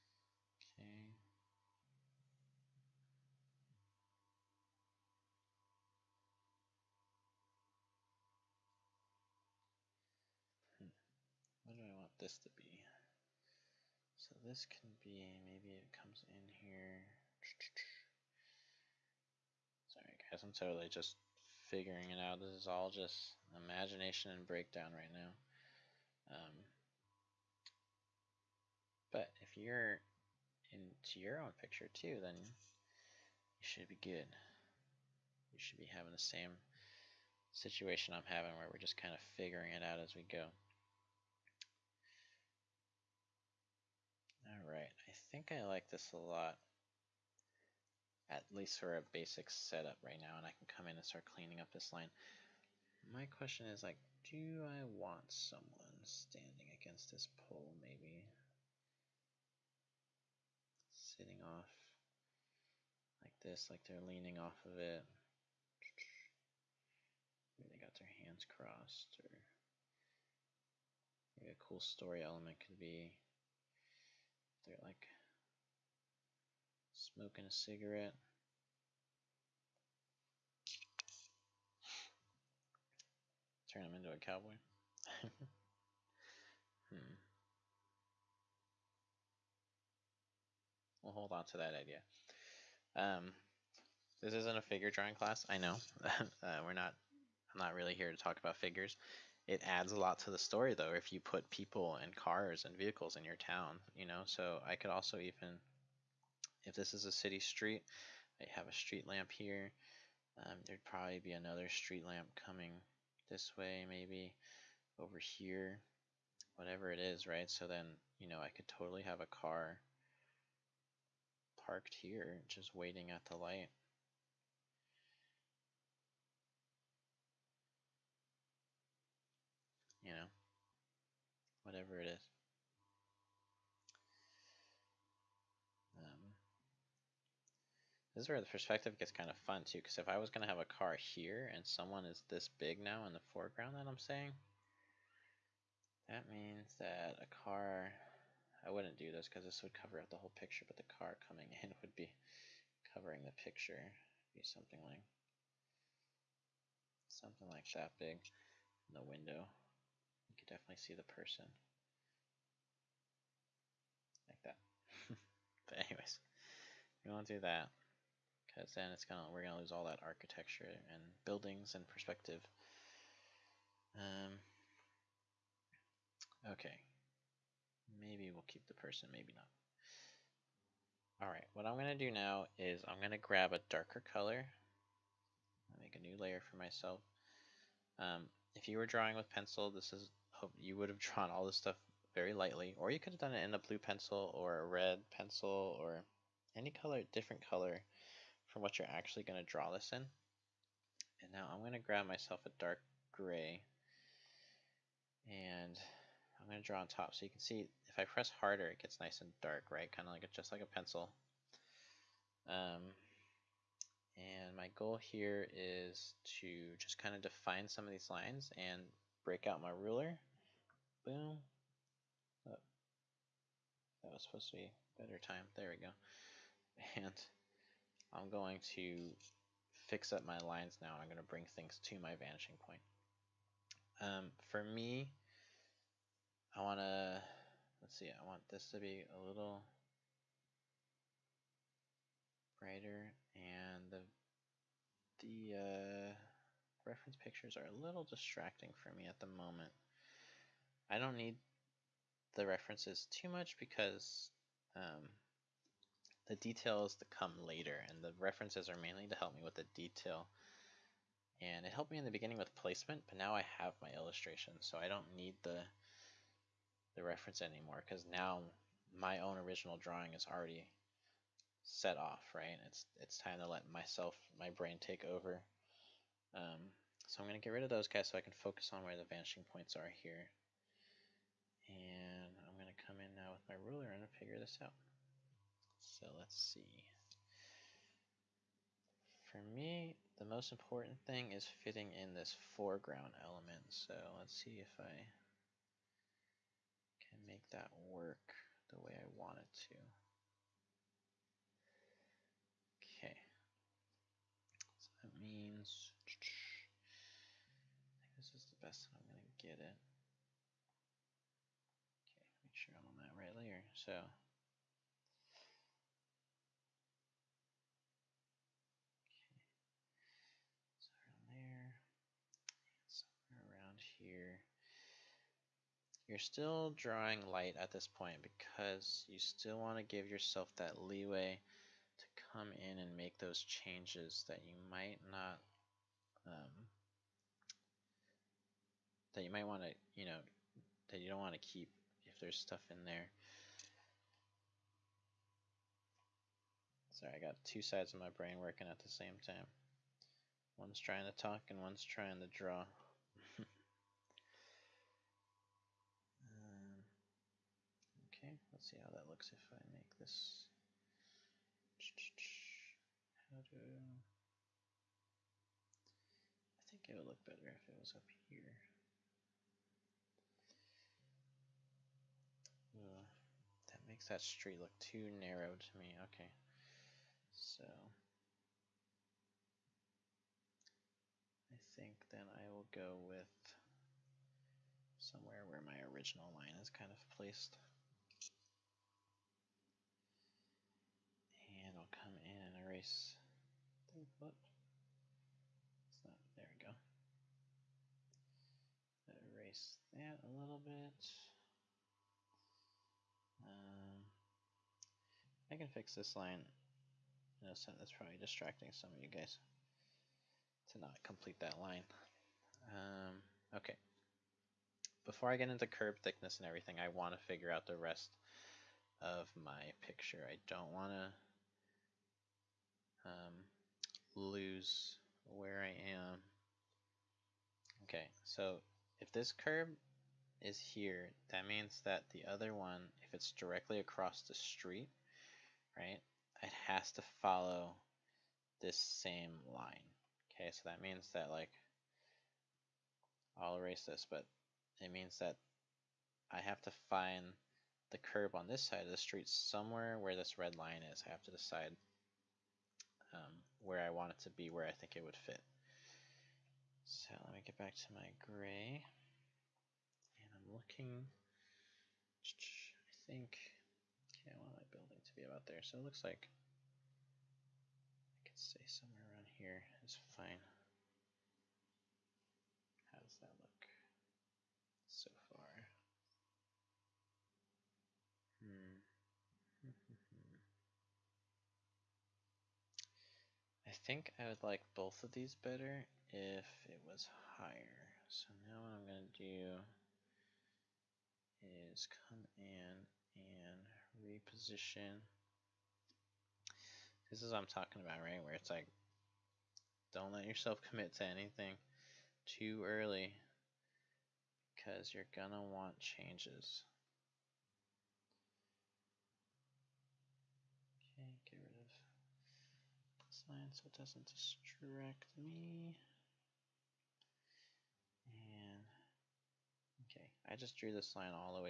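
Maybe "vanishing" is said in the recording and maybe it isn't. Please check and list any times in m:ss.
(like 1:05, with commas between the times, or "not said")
3:52, 4:39.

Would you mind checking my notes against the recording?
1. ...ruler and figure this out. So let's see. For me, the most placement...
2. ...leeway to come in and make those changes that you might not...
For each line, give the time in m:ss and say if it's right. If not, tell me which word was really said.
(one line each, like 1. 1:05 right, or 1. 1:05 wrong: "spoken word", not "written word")
1. 4:43 wrong: "important", not "placement"
2. 5:30 right.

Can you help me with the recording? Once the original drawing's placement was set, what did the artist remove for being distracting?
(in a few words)
Reference pictures.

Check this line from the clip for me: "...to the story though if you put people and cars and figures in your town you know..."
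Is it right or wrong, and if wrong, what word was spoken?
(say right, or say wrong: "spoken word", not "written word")
wrong: "vehicles", not "figures".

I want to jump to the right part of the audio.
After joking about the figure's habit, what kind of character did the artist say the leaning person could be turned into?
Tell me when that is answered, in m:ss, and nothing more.
1:24.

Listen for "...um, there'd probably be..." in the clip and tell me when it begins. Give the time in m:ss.
1:50.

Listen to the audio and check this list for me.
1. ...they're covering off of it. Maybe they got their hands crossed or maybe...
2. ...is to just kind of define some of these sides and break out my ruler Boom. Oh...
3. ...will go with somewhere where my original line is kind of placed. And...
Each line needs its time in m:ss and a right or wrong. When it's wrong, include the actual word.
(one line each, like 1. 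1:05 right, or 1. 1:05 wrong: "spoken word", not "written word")
1. 1:03 wrong: "leaning", not "covering"
2. 3:35 wrong: "lines", not "sides"
3. 6:22 right.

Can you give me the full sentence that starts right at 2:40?
You can definitely see the person.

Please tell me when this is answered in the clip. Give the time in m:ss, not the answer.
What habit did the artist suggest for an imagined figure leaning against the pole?
1:17.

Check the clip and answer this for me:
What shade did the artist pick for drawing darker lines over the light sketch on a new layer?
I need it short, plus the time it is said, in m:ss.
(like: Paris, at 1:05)
Dark gray, at 3:22.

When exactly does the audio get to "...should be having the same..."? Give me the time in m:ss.
0:35.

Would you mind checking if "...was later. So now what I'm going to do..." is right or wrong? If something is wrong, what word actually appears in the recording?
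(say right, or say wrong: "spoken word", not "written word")
wrong: "higher", not "later".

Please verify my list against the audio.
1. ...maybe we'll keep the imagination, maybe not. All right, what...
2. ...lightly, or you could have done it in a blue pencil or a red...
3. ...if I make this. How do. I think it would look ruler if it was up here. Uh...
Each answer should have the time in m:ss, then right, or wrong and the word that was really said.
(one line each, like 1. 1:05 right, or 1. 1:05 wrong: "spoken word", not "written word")
1. 2:57 wrong: "person", not "imagination"
2. 3:12 right
3. 5:59 wrong: "better", not "ruler".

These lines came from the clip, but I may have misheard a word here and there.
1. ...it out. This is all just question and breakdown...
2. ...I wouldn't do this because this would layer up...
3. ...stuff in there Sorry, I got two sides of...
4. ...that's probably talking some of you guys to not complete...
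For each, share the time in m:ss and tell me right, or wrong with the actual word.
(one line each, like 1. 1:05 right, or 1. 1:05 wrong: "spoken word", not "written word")
1. 0:22 wrong: "imagination", not "question"
2. 2:28 wrong: "cover", not "layer"
3. 5:42 right
4. 6:47 wrong: "distracting", not "talking".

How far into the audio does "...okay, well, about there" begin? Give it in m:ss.
7:44.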